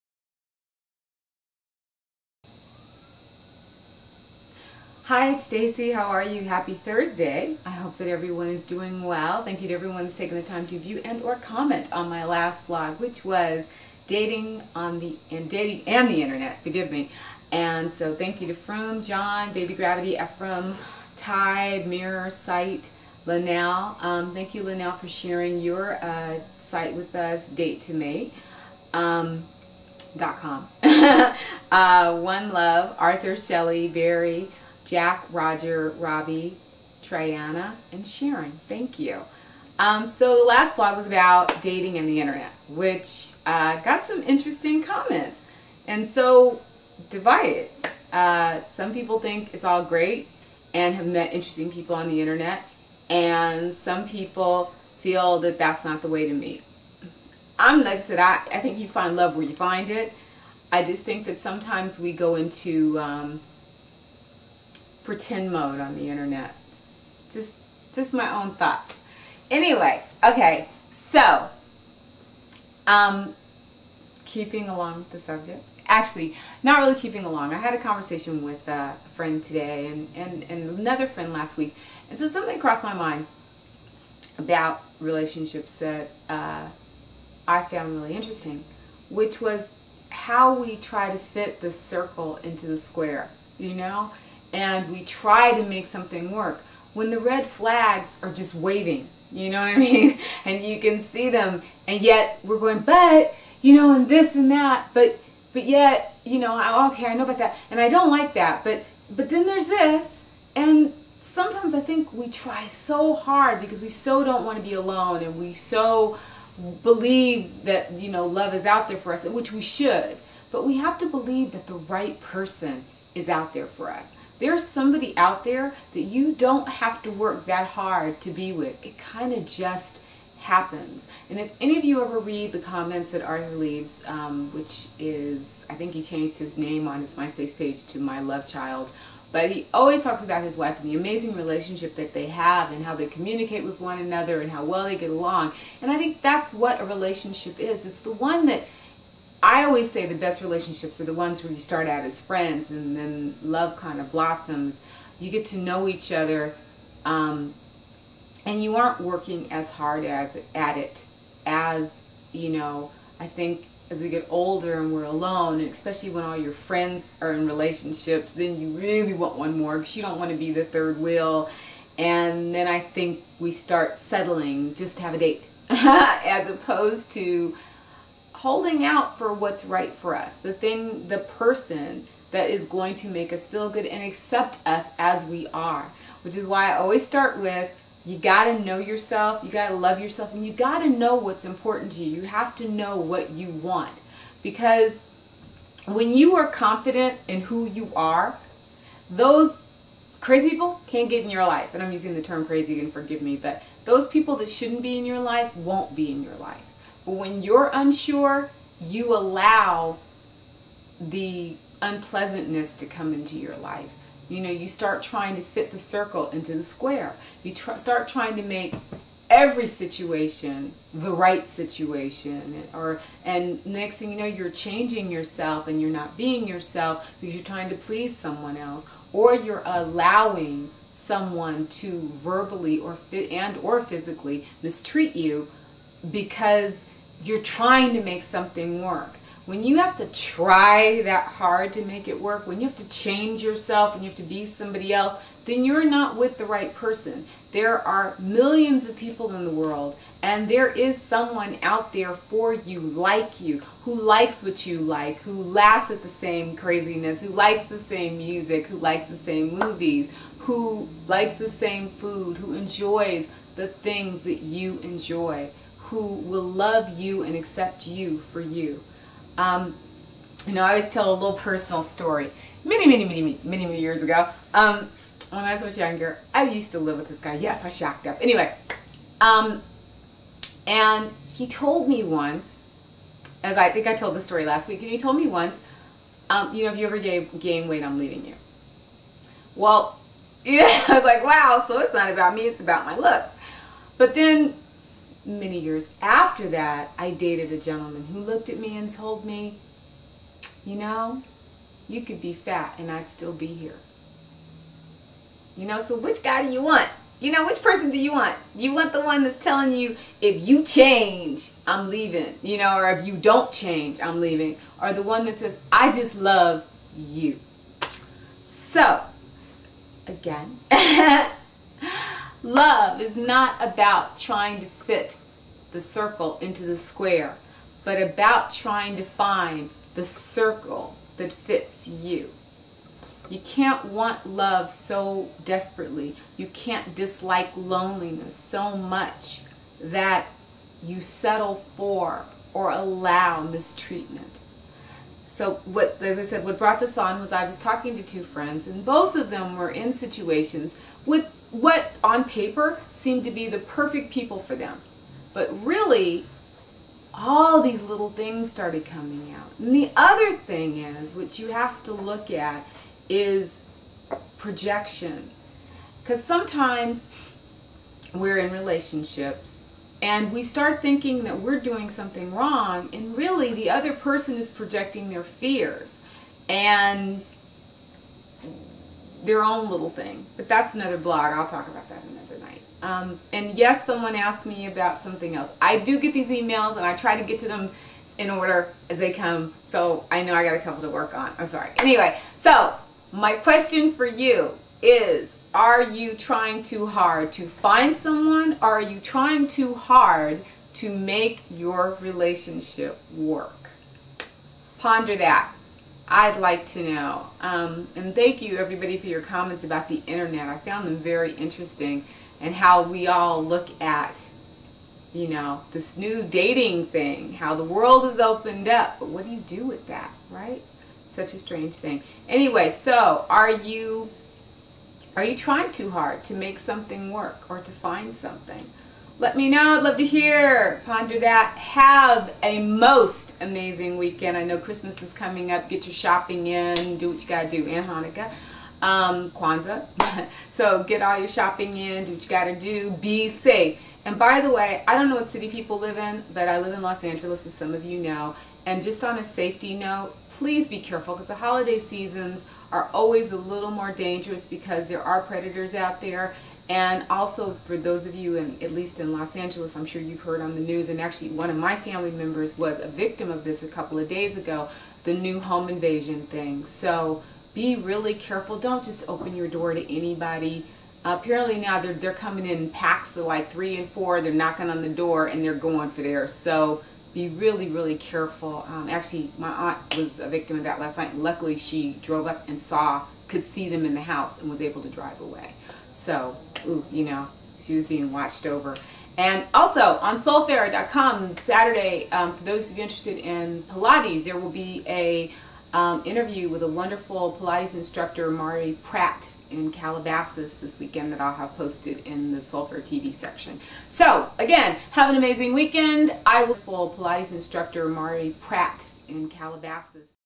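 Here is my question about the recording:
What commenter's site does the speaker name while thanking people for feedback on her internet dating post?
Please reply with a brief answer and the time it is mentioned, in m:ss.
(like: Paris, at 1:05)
Date to Me, at 0:27.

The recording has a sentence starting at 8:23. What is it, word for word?
So again, have an amazing weekend.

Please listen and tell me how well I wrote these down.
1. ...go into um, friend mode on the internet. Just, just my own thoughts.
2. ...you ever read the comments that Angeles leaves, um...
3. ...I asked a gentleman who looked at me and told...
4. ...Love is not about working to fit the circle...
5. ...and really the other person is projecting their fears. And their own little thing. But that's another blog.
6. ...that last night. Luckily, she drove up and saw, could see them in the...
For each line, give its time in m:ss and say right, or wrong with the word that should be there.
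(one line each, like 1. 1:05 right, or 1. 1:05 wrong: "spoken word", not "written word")
1. 1:02 wrong: "pretend", not "friend"
2. 2:11 wrong: "Arthur", not "Angeles"
3. 4:56 wrong: "dated", not "asked"
4. 5:22 wrong: "trying", not "working"
5. 6:12 right
6. 8:00 right.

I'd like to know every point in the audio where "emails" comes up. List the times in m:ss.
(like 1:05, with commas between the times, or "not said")
6:26.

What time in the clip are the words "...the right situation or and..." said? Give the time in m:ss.
3:40.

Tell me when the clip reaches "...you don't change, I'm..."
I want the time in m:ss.
5:13.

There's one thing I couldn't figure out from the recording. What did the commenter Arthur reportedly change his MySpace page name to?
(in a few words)
My Love Child.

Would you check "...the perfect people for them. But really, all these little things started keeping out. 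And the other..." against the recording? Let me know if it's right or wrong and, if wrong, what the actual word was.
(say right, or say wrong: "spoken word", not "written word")
wrong: "coming", not "keeping".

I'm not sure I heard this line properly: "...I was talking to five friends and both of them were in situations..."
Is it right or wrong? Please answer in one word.
wrong.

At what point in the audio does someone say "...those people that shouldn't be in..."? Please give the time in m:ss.
3:23.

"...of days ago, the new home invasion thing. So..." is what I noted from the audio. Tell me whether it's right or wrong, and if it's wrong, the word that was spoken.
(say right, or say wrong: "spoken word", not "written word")
right.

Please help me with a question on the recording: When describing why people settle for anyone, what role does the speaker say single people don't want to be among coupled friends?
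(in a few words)
third wheel.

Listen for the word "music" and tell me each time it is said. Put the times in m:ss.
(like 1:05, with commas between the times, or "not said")
4:18.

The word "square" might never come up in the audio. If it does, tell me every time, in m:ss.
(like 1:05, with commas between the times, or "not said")
1:32, 3:36, 5:26.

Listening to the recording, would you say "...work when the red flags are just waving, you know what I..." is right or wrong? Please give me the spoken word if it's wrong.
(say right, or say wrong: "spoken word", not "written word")
right.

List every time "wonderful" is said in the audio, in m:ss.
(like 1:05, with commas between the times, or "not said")
8:16.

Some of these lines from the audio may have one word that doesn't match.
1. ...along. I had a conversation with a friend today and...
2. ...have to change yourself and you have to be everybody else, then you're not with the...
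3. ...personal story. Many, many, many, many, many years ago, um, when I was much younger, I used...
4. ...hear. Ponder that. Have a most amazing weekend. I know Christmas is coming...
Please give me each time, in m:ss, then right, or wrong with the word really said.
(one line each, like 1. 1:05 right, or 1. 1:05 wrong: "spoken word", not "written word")
1. 1:17 right
2. 4:02 wrong: "somebody", not "everybody"
3. 4:31 right
4. 7:10 right.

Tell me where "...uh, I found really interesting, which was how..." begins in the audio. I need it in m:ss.
1:26.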